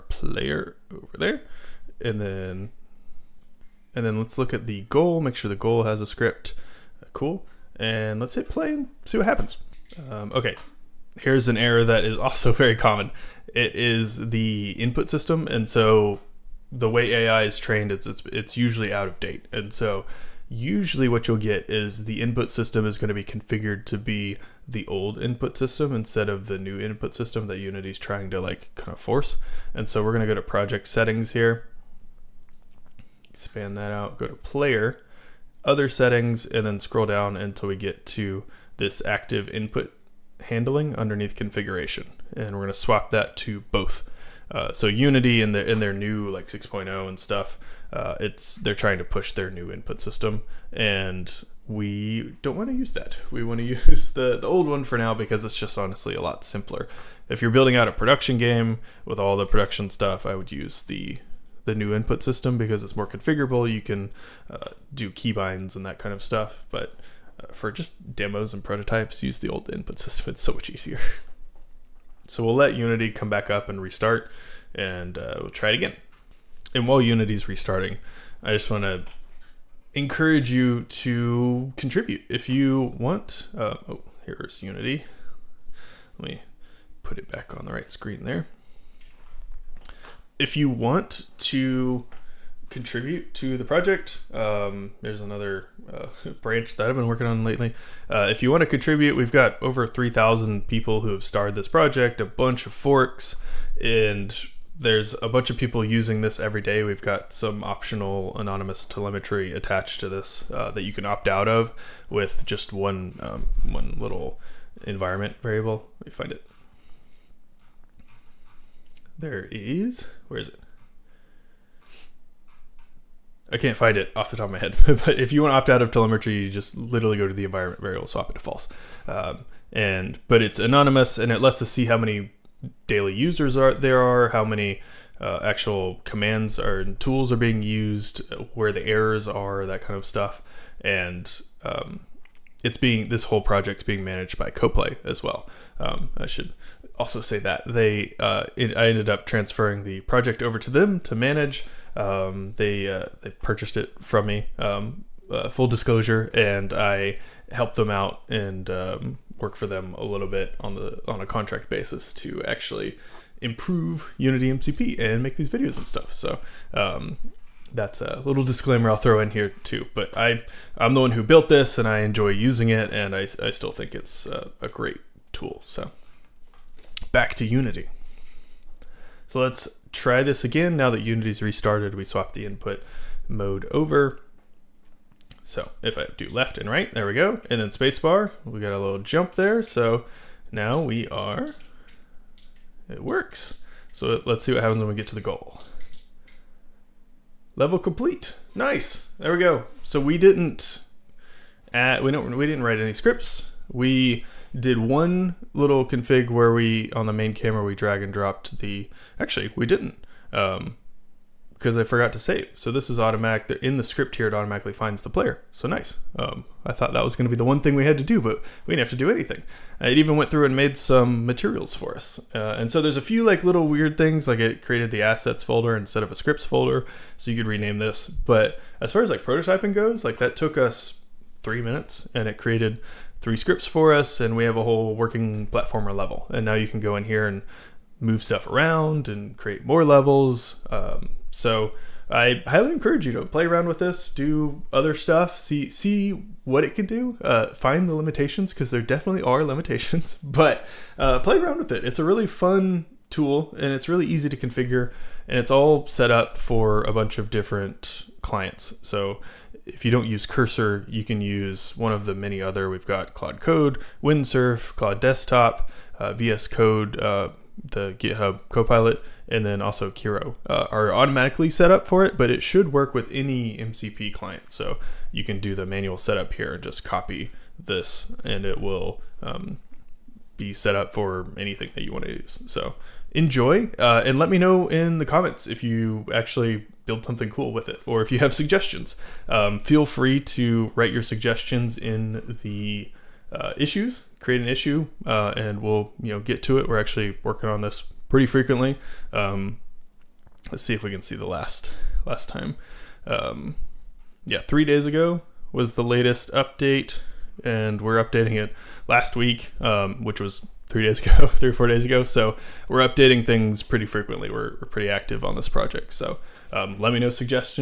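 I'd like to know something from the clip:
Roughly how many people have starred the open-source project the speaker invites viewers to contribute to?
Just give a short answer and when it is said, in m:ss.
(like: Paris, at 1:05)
3,000, at 1:39.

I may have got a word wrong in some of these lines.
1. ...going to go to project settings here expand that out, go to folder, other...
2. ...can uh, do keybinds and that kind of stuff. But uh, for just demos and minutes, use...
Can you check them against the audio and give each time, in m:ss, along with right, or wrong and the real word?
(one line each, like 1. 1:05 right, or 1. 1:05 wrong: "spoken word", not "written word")
1. 0:30 wrong: "player", not "folder"
2. 1:03 wrong: "prototypes", not "minutes".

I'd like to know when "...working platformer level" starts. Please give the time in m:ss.
3:54.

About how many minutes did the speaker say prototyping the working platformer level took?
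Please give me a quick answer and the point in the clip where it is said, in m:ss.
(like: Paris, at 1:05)
3, at 3:51.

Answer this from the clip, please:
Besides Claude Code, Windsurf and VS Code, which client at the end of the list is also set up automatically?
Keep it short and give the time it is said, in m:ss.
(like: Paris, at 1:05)
Kiro, at 4:29.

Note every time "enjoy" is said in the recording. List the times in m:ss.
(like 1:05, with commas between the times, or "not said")
2:51, 4:43.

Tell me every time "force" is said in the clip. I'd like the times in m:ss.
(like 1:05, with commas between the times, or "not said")
0:28.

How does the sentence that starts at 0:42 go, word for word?
And we're gonna swap that to both.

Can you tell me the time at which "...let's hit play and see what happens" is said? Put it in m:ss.
0:08.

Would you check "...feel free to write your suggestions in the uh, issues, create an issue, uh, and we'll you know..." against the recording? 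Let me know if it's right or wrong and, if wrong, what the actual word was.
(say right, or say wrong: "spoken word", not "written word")
right.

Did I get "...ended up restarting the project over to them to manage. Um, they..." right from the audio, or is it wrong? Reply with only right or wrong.
wrong.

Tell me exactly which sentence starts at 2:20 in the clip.
And um, it's being this whole project's being managed by CoPlay as well.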